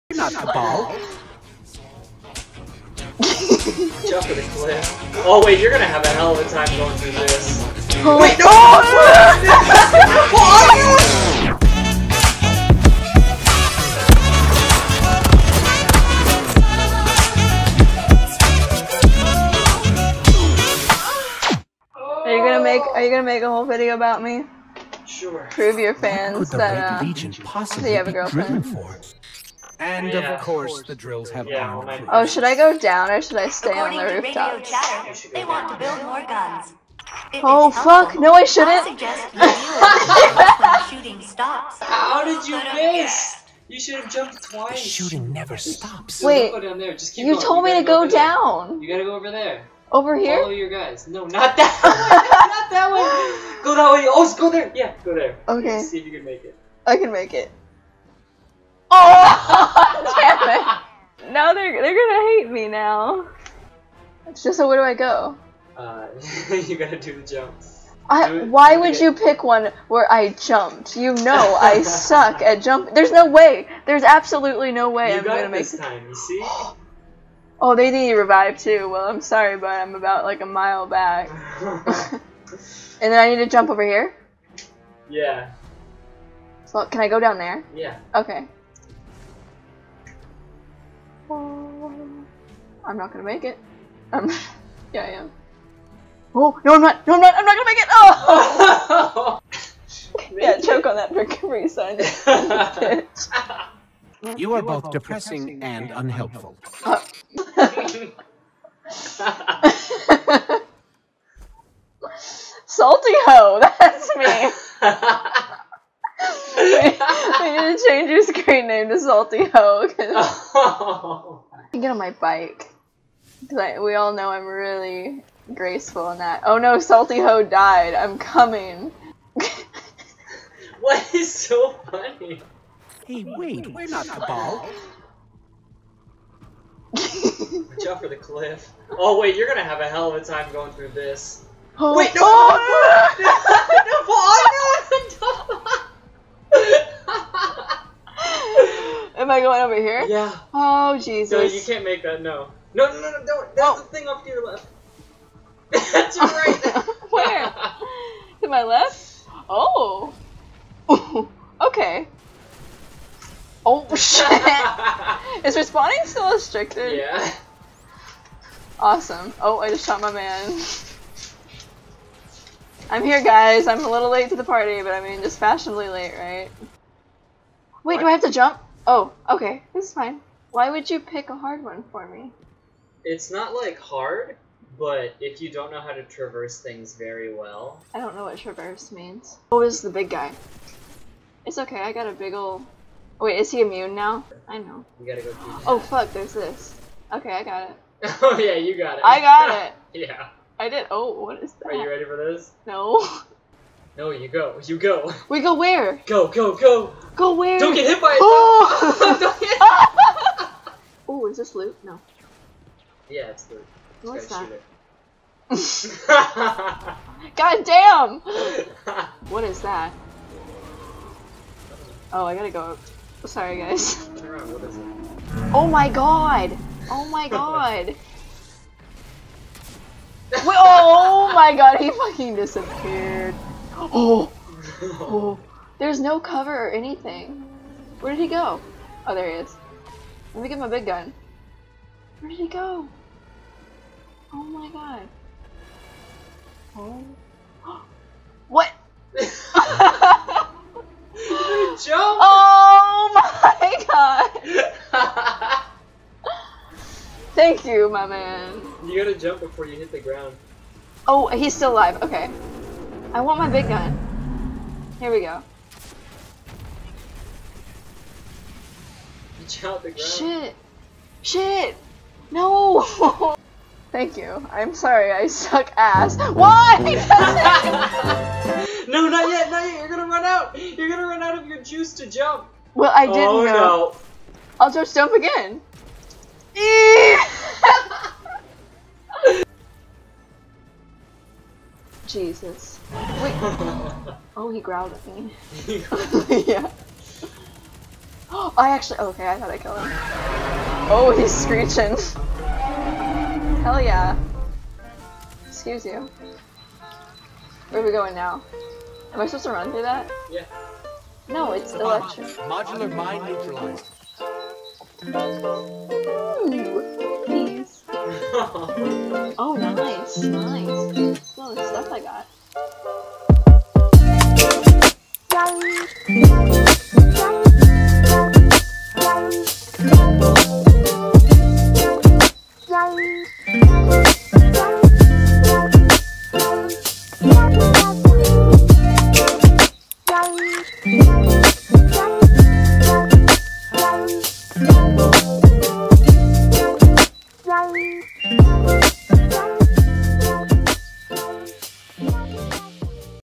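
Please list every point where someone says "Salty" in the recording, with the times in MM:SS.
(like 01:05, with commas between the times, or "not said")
01:52, 01:58, 02:06.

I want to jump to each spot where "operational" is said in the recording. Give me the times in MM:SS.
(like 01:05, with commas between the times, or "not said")
not said.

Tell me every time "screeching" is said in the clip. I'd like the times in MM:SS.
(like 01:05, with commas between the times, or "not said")
05:01.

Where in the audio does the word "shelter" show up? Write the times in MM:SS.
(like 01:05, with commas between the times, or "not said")
not said.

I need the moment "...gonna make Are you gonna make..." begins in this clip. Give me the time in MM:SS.
00:22.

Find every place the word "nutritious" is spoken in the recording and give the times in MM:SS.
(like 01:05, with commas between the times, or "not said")
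not said.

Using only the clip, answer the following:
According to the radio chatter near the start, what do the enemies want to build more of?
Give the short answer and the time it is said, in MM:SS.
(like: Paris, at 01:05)
guns, at 00:36.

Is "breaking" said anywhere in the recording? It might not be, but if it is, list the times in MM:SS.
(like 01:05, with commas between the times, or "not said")
not said.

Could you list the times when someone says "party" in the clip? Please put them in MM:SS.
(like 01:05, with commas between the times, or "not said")
02:54.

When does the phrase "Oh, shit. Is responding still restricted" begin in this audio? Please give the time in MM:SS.
02:43.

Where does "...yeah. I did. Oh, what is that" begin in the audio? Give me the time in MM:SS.
03:19.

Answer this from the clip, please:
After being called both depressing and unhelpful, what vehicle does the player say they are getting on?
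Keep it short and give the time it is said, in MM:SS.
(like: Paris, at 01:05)
bike, at 02:02.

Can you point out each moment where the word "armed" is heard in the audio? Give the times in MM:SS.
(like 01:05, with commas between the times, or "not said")
00:31.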